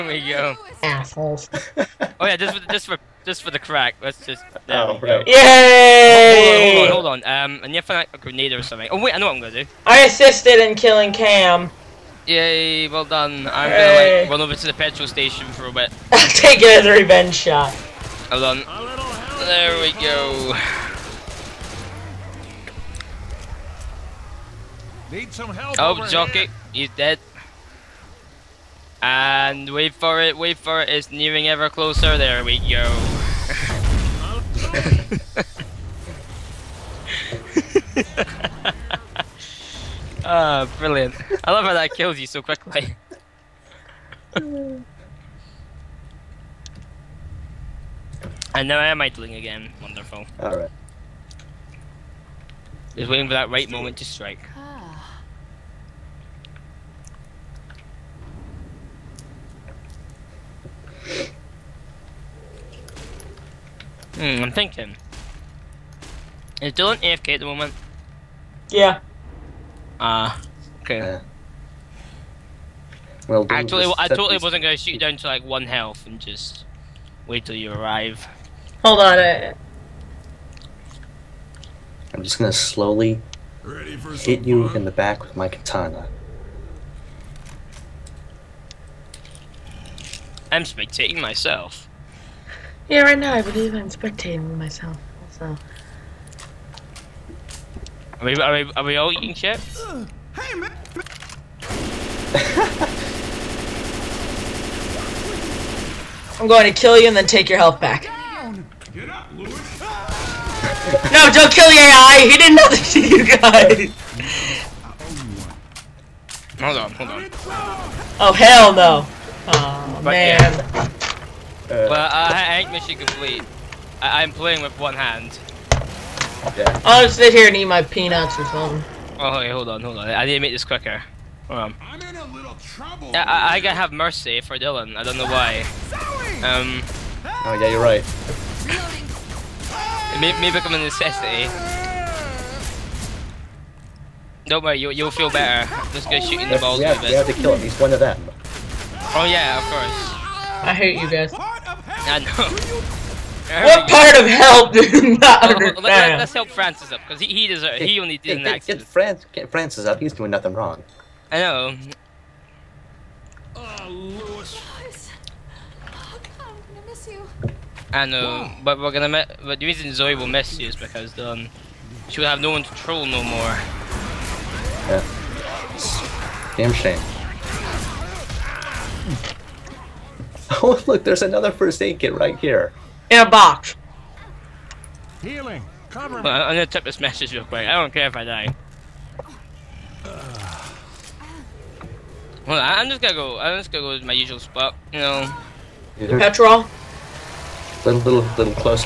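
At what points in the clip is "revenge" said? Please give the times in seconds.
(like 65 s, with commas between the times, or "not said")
16 s.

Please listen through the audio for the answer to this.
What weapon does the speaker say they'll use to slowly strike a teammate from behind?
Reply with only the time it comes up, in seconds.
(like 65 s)
85 s.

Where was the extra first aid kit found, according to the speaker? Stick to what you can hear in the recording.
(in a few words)
In a box.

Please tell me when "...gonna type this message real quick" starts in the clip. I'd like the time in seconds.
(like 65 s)
186 s.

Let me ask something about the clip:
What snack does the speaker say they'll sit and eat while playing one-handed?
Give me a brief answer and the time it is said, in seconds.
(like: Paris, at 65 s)
peanuts, at 127 s.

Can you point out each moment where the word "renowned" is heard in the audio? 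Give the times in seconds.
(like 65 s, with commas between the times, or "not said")
not said.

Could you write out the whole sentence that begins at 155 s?
Let, us help Francis up, because he, he, deserves, he only did hey, an get, accident.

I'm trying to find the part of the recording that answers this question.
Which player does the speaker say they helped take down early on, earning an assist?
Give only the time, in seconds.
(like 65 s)
11 s.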